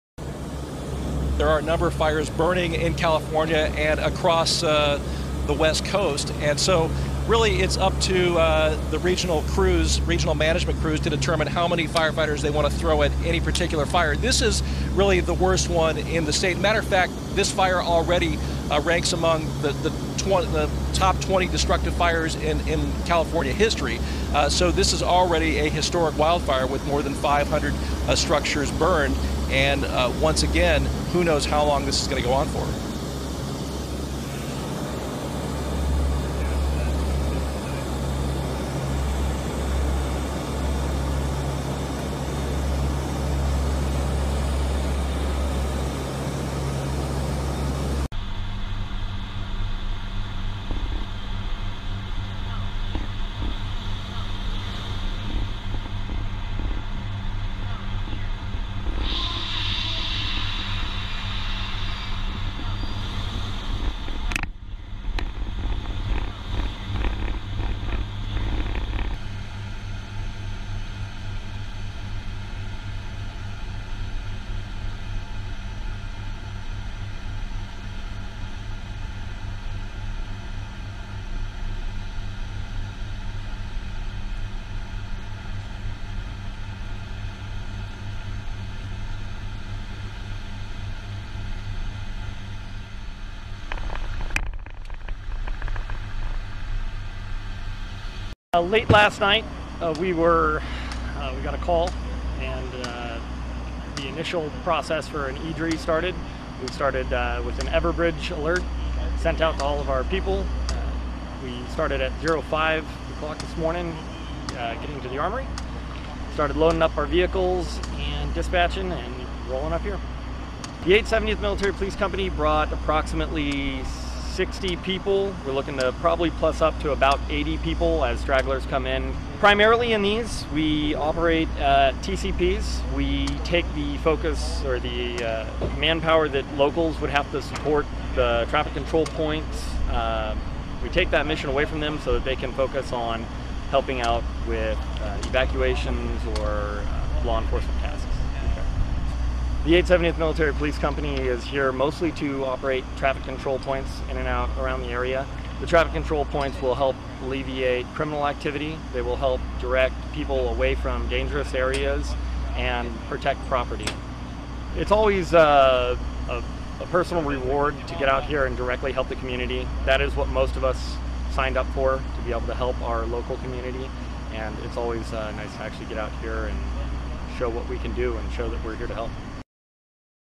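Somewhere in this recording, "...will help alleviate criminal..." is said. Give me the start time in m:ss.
2:36.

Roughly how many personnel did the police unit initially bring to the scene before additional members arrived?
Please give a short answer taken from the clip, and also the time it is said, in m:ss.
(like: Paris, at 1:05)
60, at 2:02.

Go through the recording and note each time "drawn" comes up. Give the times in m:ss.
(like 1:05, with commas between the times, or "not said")
not said.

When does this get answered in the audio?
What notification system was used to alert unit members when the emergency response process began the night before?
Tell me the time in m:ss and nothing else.
1:47.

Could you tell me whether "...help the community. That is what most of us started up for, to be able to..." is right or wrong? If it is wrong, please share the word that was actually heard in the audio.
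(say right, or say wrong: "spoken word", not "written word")
wrong: "signed", not "started".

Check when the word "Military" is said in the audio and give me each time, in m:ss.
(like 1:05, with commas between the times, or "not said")
2:01, 2:30.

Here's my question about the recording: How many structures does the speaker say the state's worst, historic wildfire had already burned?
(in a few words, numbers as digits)
more than 500.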